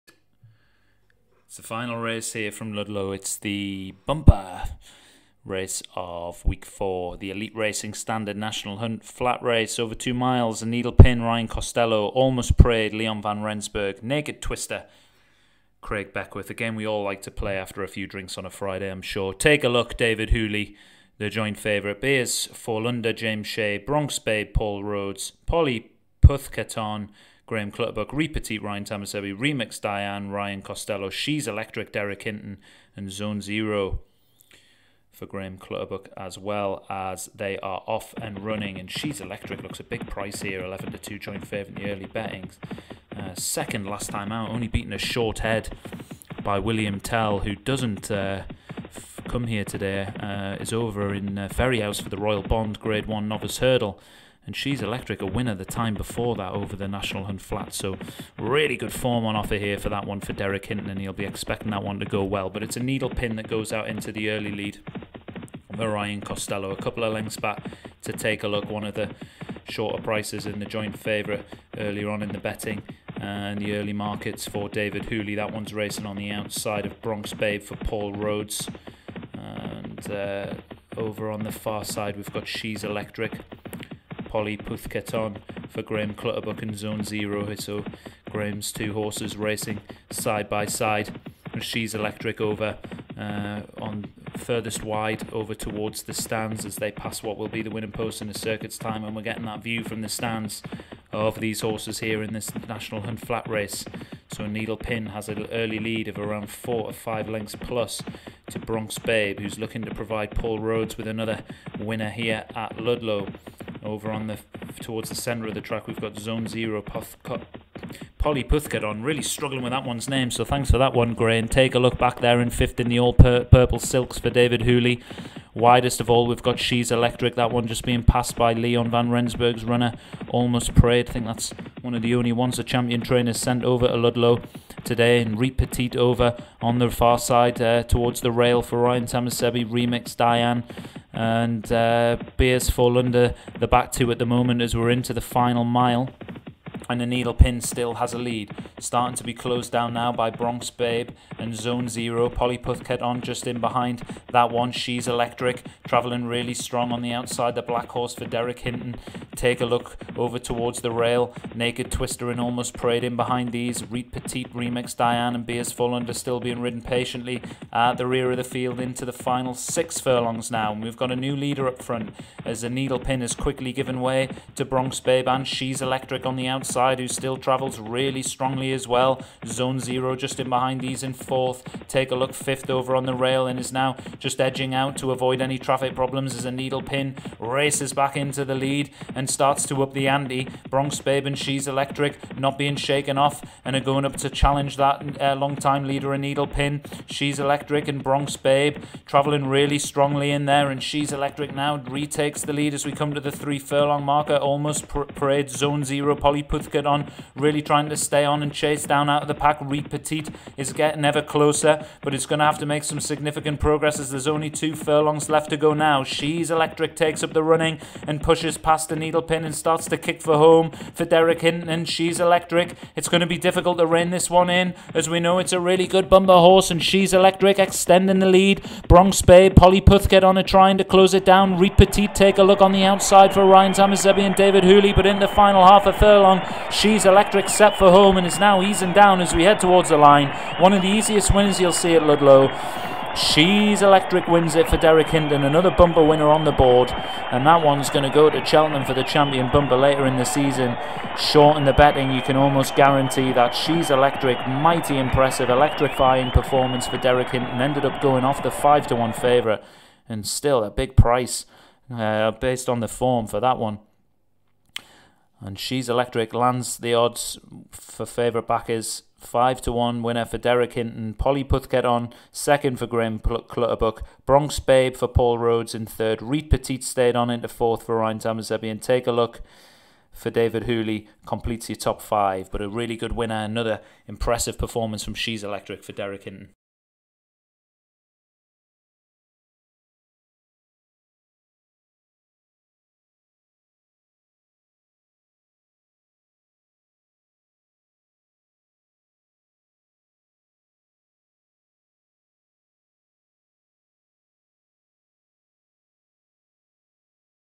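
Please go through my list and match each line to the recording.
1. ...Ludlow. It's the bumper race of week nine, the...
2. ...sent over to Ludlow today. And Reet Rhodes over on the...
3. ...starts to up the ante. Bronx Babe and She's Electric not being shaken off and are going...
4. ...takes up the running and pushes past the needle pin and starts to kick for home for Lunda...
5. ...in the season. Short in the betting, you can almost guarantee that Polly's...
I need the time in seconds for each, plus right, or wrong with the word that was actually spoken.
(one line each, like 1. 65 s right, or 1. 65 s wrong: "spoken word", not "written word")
1. 2 s wrong: "four", not "nine"
2. 133 s wrong: "Petite", not "Rhodes"
3. 189 s right
4. 216 s wrong: "Derek", not "Lunda"
5. 250 s wrong: "She", not "Polly".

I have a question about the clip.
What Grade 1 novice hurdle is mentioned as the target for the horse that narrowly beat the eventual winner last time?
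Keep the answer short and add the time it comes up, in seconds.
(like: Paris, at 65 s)
Royal Bond, at 52 s.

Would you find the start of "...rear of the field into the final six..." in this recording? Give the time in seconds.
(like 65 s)
168 s.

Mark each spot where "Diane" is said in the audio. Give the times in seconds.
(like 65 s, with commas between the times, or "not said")
29 s, 140 s, 164 s.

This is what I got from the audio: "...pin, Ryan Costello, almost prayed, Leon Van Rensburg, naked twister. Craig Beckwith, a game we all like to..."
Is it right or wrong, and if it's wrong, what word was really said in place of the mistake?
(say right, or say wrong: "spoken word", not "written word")
right.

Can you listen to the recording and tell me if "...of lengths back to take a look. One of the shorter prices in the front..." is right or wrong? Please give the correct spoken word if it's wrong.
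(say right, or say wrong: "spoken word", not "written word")
wrong: "joint", not "front".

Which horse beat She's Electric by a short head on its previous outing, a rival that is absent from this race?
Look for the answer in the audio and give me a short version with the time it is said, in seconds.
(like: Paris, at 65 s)
William Tell, at 46 s.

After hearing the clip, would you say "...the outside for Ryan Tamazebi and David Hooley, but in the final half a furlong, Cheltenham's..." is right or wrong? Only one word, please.
wrong.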